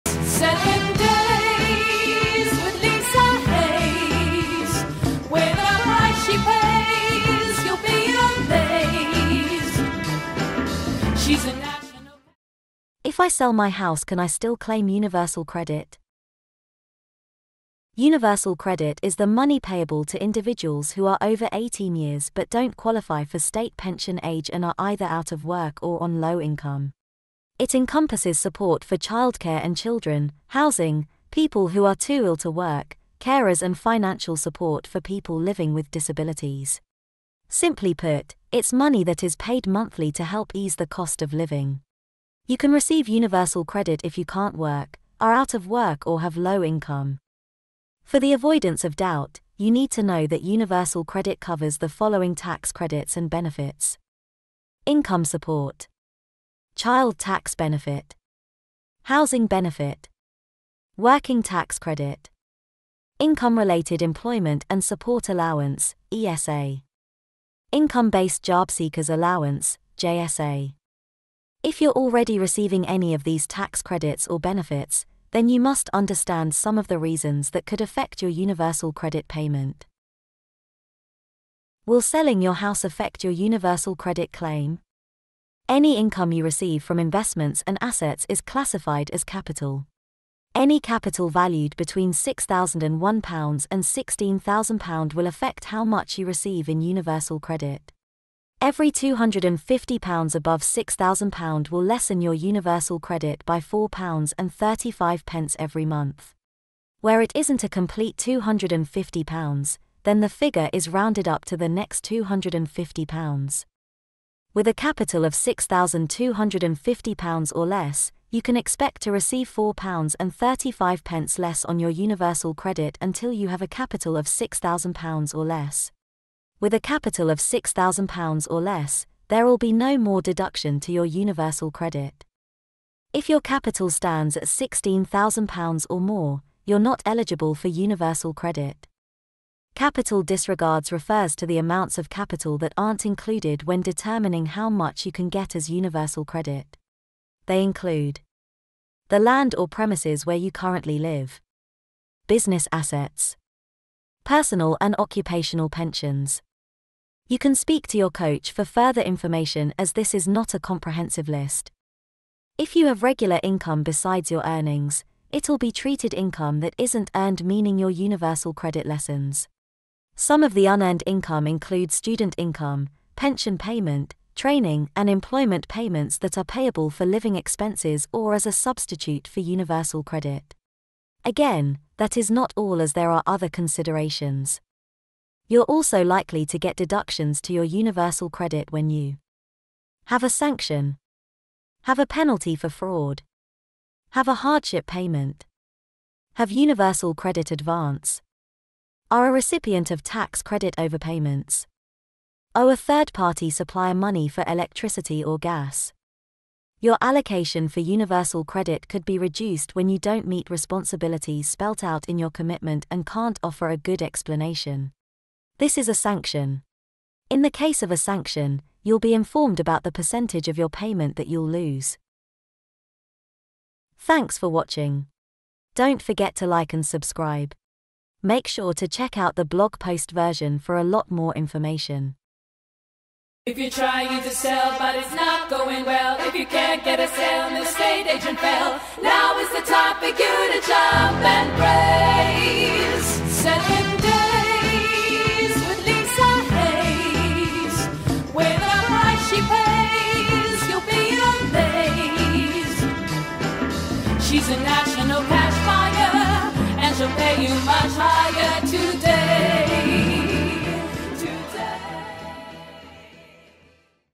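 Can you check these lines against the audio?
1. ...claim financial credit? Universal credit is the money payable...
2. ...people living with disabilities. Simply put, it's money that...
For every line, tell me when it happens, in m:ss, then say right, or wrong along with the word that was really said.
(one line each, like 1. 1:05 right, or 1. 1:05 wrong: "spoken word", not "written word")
1. 0:14 wrong: "universal", not "financial"
2. 0:34 right.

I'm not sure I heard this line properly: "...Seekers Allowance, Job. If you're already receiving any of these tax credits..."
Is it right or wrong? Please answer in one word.
wrong.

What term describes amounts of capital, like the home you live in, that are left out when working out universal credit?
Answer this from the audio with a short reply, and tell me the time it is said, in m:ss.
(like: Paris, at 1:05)
Capital disregards, at 2:19.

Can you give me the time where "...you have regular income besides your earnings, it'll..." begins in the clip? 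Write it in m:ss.
2:42.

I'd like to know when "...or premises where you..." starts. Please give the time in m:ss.
2:29.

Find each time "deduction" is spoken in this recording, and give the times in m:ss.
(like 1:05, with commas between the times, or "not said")
2:10, 3:06.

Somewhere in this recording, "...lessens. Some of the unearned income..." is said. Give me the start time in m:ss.
2:48.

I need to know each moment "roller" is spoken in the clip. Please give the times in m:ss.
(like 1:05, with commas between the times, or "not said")
not said.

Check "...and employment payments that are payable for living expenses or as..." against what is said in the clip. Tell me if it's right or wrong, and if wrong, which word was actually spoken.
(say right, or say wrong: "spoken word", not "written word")
right.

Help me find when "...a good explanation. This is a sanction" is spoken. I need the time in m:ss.
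3:33.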